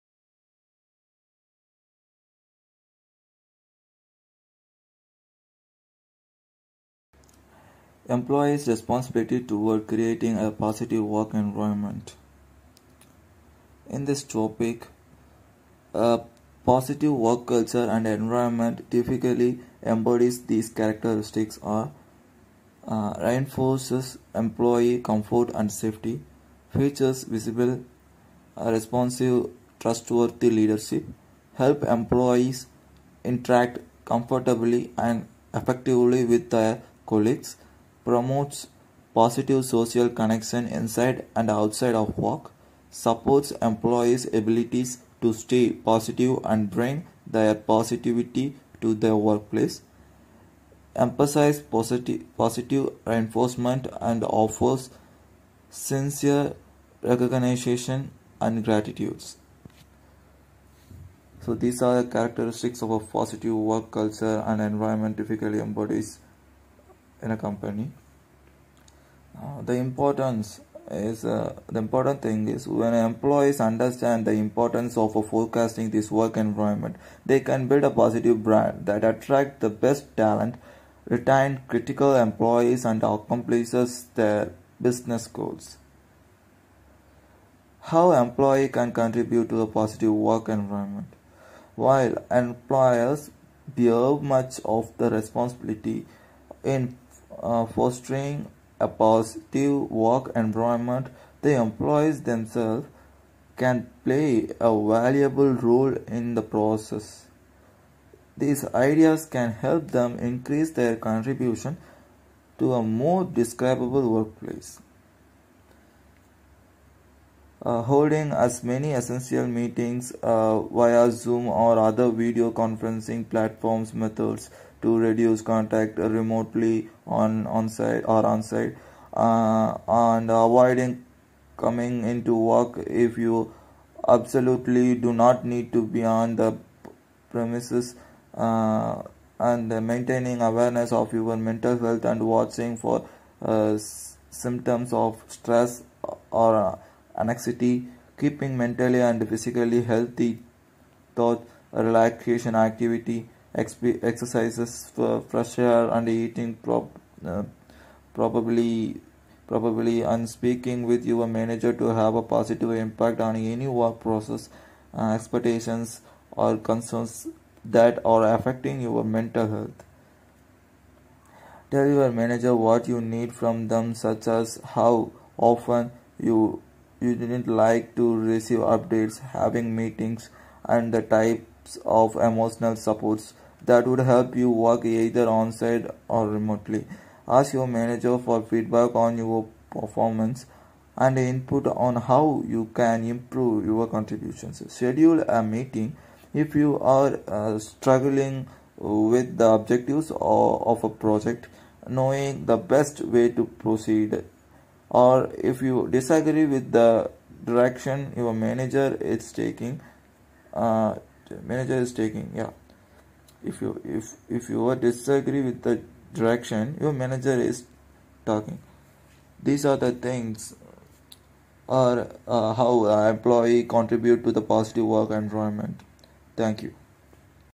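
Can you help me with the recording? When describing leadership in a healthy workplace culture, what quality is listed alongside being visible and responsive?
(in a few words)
trustworthy.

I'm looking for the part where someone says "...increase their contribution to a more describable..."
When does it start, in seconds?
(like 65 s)
110 s.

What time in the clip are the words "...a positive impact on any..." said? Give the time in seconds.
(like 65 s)
162 s.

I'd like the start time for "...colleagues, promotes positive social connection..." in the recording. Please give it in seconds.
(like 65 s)
37 s.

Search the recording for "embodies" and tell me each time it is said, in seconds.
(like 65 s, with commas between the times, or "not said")
19 s, 65 s.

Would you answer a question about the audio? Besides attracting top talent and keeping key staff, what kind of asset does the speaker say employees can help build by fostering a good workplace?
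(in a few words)
positive brand.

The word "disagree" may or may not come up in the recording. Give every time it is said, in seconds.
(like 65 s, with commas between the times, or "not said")
205 s, 214 s.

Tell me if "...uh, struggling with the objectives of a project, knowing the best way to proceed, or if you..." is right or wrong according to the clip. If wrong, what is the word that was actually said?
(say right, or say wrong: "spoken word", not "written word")
right.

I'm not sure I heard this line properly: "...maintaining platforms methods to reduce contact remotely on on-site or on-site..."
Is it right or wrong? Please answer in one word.
wrong.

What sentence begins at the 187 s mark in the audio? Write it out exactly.
Ask your manager for feedback on your performance and input on how you can improve your contributions.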